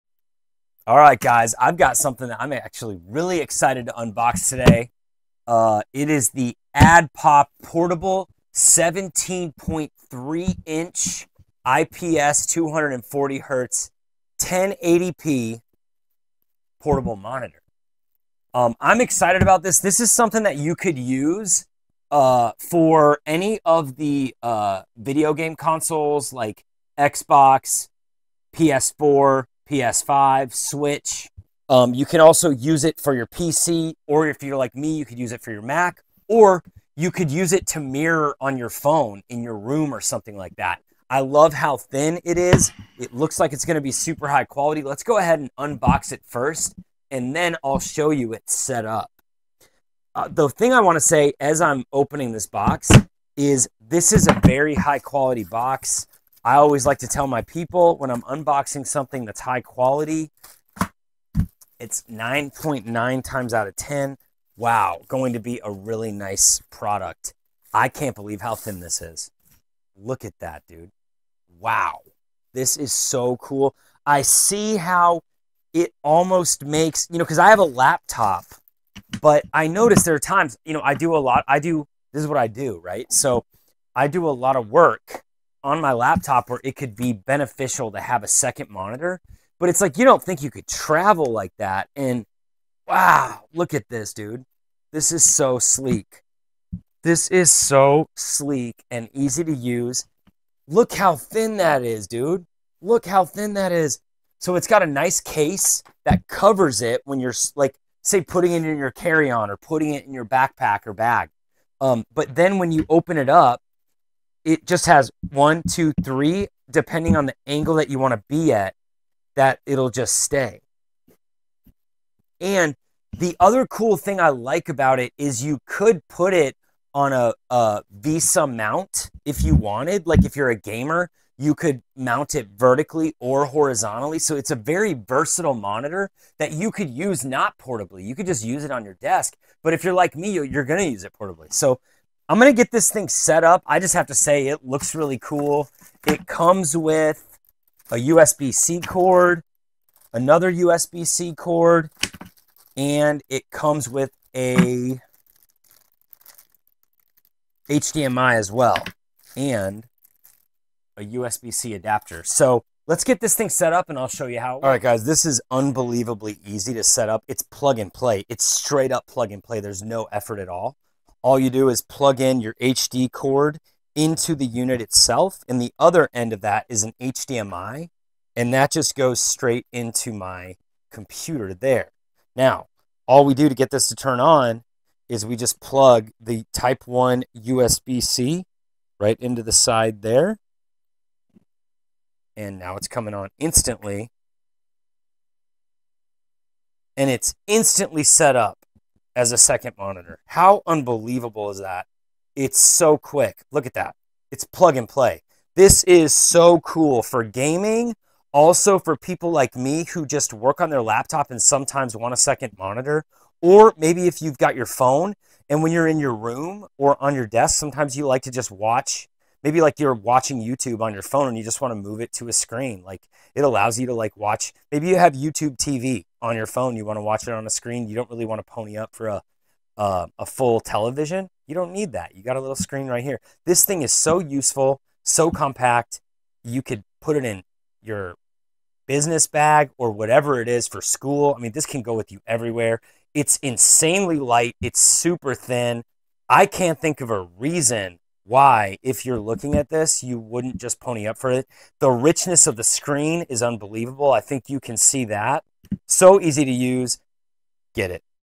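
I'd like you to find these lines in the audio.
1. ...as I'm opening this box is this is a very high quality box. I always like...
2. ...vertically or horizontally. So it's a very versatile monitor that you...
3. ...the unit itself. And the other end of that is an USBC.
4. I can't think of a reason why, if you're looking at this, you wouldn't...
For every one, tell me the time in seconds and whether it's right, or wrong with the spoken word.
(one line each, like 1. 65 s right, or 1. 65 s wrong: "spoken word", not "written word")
1. 51 s right
2. 132 s right
3. 174 s wrong: "HDMI", not "USBC"
4. 246 s right.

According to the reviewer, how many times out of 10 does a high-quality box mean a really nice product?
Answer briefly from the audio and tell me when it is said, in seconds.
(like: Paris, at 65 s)
9.9, at 62 s.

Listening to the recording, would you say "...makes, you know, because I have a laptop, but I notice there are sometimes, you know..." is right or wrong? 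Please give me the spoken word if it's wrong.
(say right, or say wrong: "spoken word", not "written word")
wrong: "times", not "sometimes".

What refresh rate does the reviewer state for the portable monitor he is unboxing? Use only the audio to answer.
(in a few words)
240 hertz.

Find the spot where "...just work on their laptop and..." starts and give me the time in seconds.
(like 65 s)
210 s.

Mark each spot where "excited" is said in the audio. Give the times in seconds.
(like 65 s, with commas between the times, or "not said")
3 s, 19 s.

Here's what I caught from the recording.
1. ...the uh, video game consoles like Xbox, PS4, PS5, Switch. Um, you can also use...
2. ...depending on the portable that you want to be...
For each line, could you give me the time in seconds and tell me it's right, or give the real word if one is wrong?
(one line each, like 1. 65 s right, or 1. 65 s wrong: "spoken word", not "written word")
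1. 23 s right
2. 116 s wrong: "angle", not "portable".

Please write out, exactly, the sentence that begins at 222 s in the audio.
Like it allows you to like watch, maybe you have YouTube TV on your phone.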